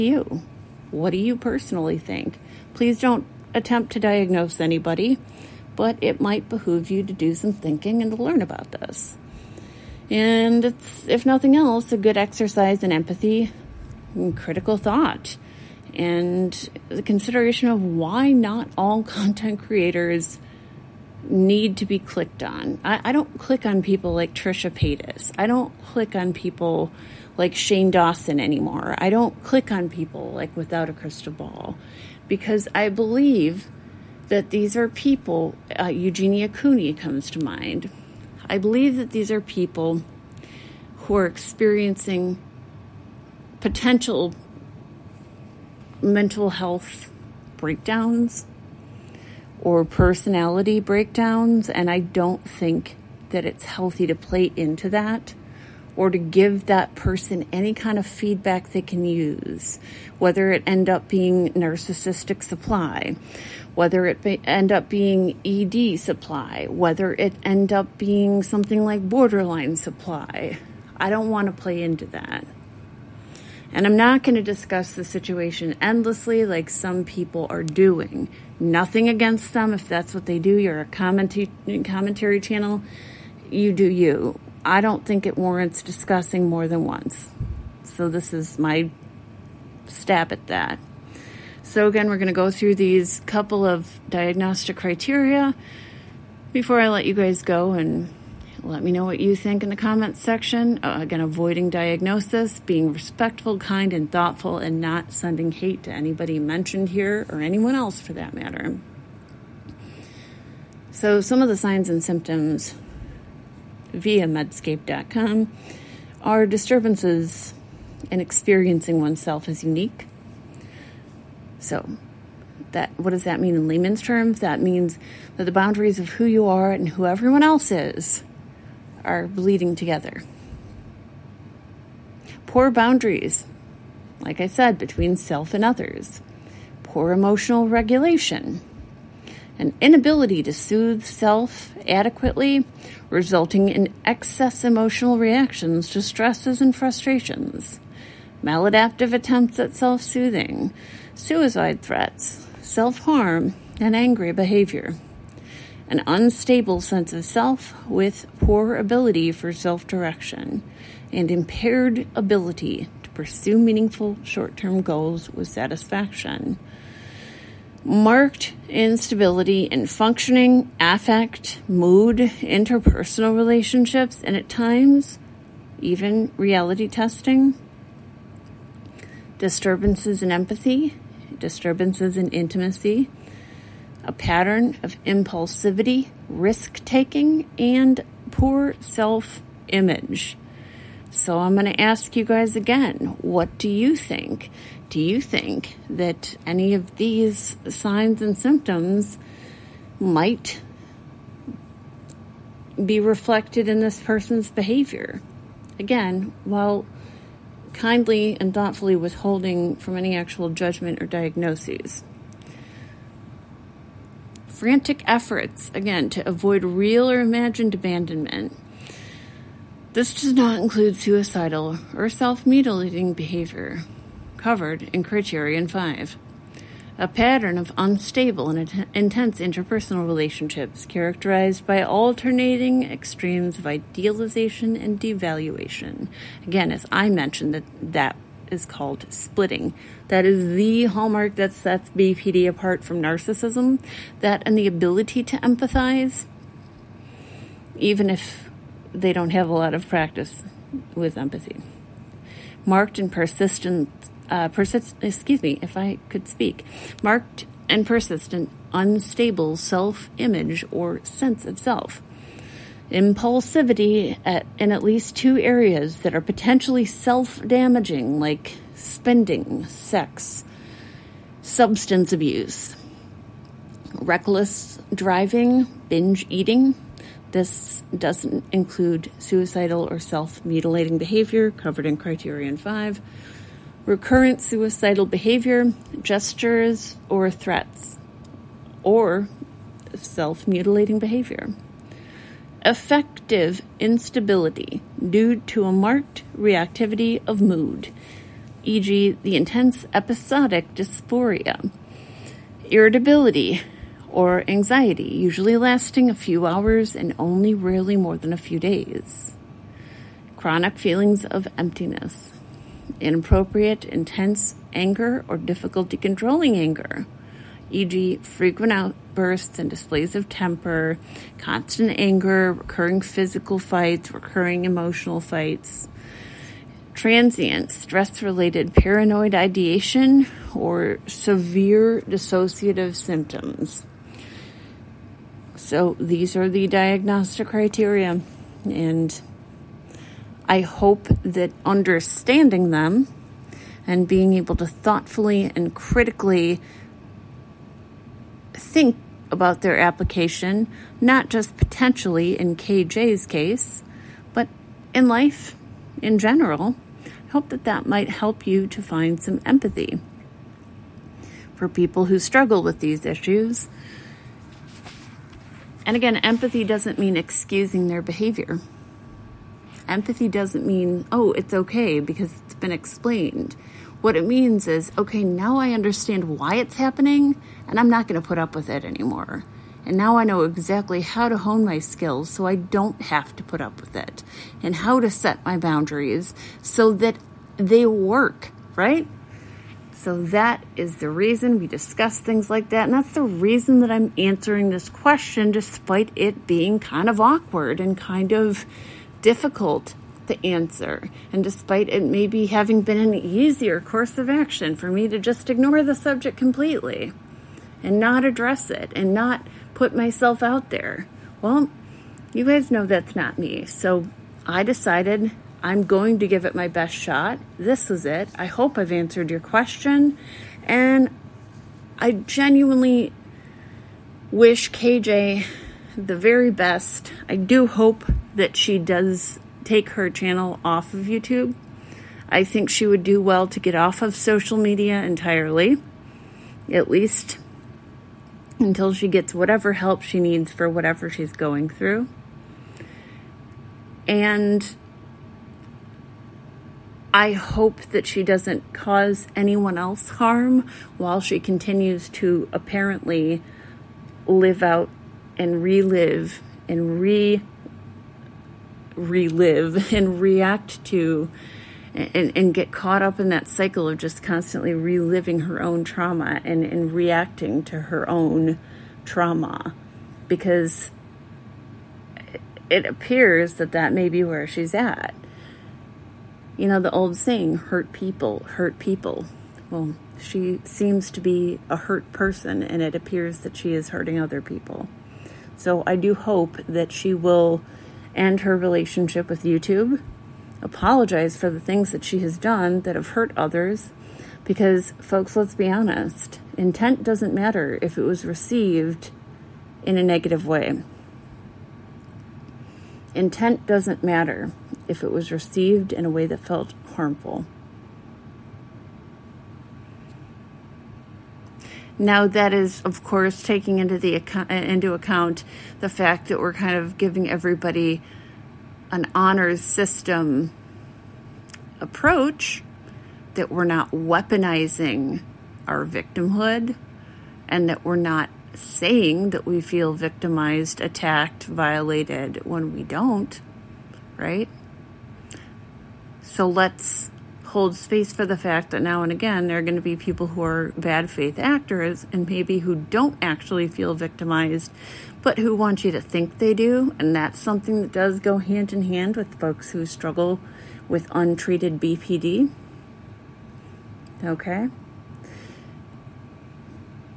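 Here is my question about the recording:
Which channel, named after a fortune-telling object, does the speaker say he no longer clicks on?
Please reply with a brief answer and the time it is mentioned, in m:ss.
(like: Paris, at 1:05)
Without a Crystal Ball, at 0:30.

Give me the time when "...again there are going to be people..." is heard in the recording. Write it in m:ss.
8:59.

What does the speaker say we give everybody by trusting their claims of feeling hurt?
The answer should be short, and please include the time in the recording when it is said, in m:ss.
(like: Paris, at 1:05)
Honors system, at 8:39.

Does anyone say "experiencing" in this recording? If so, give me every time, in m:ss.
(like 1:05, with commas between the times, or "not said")
0:41, 1:58.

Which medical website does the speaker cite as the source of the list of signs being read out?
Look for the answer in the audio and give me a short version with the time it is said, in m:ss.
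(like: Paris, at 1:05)
medscape.com, at 1:54.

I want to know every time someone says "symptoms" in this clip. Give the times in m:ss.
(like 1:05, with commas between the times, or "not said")
1:52, 3:18, 5:32.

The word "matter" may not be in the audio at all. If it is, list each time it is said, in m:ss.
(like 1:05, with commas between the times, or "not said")
1:48, 8:17, 8:24.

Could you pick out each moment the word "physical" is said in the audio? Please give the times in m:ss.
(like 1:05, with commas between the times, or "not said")
5:23.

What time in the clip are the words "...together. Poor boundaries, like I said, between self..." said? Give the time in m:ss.
2:09.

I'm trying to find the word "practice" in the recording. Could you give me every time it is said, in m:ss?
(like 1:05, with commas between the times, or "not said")
4:09.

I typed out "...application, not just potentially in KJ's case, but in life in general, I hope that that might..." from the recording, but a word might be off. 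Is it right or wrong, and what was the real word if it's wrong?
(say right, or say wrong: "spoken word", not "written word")
right.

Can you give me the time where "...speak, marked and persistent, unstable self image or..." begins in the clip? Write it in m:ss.
4:16.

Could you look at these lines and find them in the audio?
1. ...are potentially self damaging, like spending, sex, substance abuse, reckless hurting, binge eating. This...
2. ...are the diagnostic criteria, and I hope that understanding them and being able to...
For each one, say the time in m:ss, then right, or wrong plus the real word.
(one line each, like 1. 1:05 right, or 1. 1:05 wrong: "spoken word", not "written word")
1. 4:26 wrong: "driving", not "hurting"
2. 5:36 right.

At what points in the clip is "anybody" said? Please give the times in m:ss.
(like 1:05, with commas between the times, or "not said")
0:04, 1:45.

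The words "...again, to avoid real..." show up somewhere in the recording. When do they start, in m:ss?
3:35.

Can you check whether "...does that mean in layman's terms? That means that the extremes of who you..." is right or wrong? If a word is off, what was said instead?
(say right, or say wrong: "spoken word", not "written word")
wrong: "boundaries", not "extremes".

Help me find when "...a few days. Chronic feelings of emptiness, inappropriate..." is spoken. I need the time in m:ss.
5:08.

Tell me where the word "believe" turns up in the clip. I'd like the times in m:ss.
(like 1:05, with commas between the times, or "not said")
0:32, 0:38.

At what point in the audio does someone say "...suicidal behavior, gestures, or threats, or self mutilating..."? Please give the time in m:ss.
4:44.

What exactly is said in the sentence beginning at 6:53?
So I decided I'm going to give it my best shot.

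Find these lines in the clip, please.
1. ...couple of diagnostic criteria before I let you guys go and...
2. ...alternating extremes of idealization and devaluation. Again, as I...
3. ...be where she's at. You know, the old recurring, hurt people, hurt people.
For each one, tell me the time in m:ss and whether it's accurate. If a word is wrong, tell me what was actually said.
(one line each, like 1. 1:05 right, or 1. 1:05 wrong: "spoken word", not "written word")
1. 1:33 right
2. 3:51 right
3. 7:54 wrong: "saying", not "recurring".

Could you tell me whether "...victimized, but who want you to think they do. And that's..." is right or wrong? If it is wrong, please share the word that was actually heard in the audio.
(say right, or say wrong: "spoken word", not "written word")
right.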